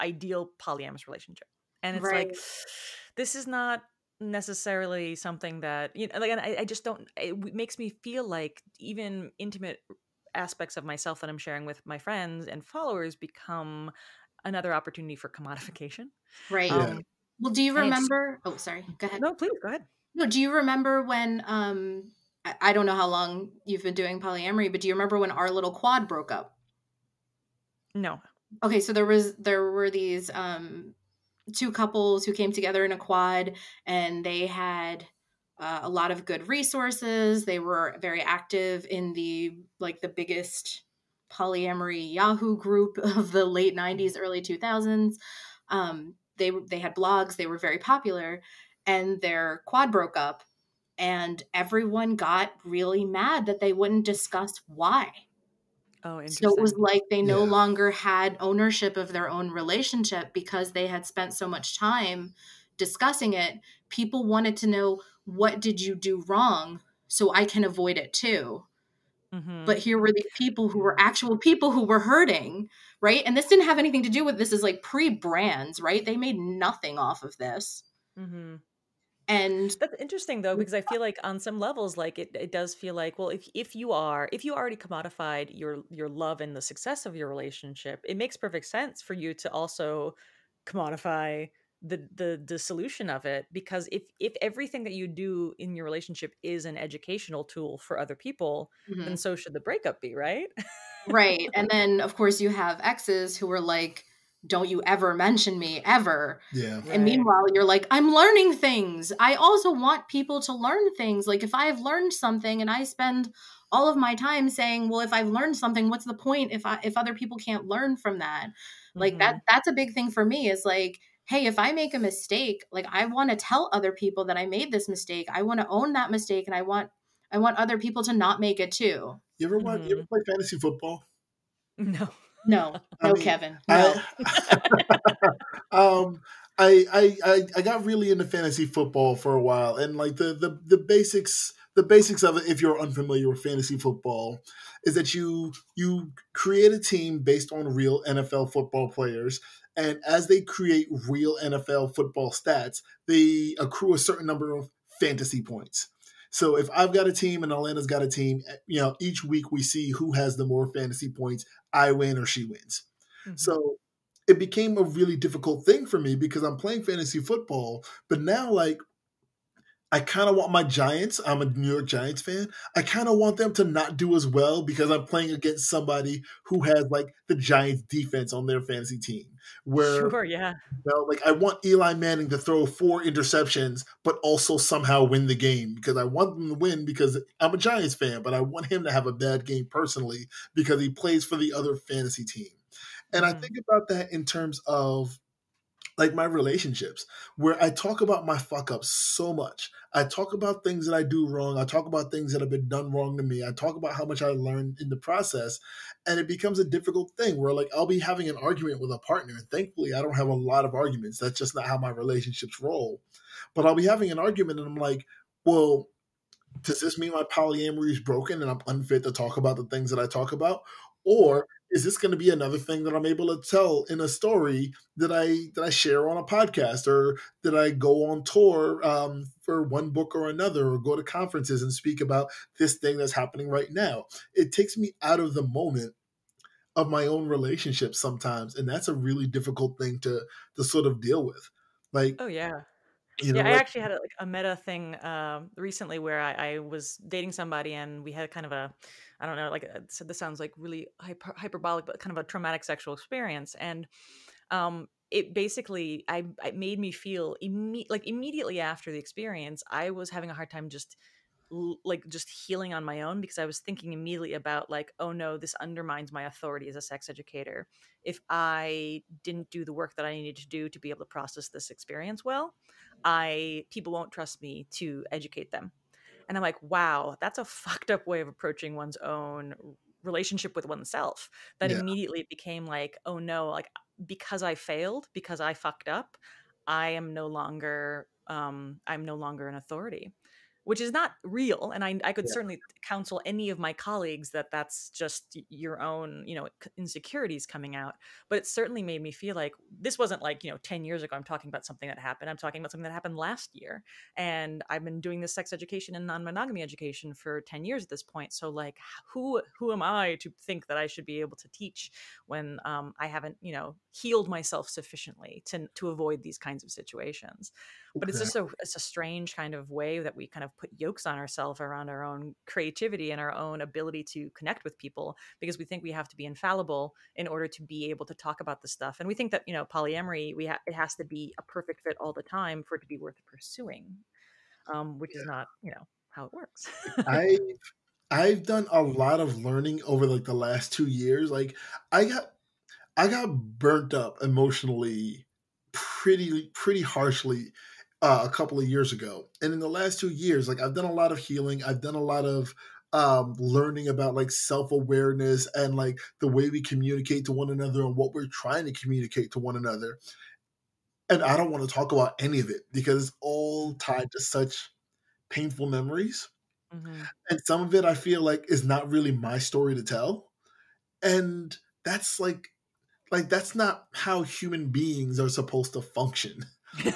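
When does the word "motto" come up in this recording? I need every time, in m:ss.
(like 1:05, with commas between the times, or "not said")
not said.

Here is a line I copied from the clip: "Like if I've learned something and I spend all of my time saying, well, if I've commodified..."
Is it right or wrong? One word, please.
wrong.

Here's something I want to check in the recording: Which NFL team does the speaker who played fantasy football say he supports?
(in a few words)
New York Giants.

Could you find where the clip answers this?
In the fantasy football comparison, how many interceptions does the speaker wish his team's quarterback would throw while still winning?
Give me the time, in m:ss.
3:02.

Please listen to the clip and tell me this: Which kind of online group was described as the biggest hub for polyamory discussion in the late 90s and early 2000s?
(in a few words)
Yahoo group.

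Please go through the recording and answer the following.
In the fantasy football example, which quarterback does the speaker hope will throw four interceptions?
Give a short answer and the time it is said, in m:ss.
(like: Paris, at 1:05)
Eli Manning, at 3:01.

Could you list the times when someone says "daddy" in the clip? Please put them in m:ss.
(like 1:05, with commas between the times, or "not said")
not said.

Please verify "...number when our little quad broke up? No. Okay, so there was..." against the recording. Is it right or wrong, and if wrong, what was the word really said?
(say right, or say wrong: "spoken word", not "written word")
wrong: "remember", not "number".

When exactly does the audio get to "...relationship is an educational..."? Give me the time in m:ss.
1:35.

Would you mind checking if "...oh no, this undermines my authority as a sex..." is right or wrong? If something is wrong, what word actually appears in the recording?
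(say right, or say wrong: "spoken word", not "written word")
right.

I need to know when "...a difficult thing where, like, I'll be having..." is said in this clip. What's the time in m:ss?
3:26.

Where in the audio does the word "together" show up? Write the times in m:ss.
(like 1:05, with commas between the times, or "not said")
0:32.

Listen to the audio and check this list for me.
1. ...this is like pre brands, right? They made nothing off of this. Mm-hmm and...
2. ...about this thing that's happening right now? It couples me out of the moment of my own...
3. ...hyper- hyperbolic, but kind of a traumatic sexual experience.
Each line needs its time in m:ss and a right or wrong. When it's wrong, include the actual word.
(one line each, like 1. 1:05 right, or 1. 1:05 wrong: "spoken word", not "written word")
1. 1:14 right
2. 3:52 wrong: "takes", not "couples"
3. 4:10 right.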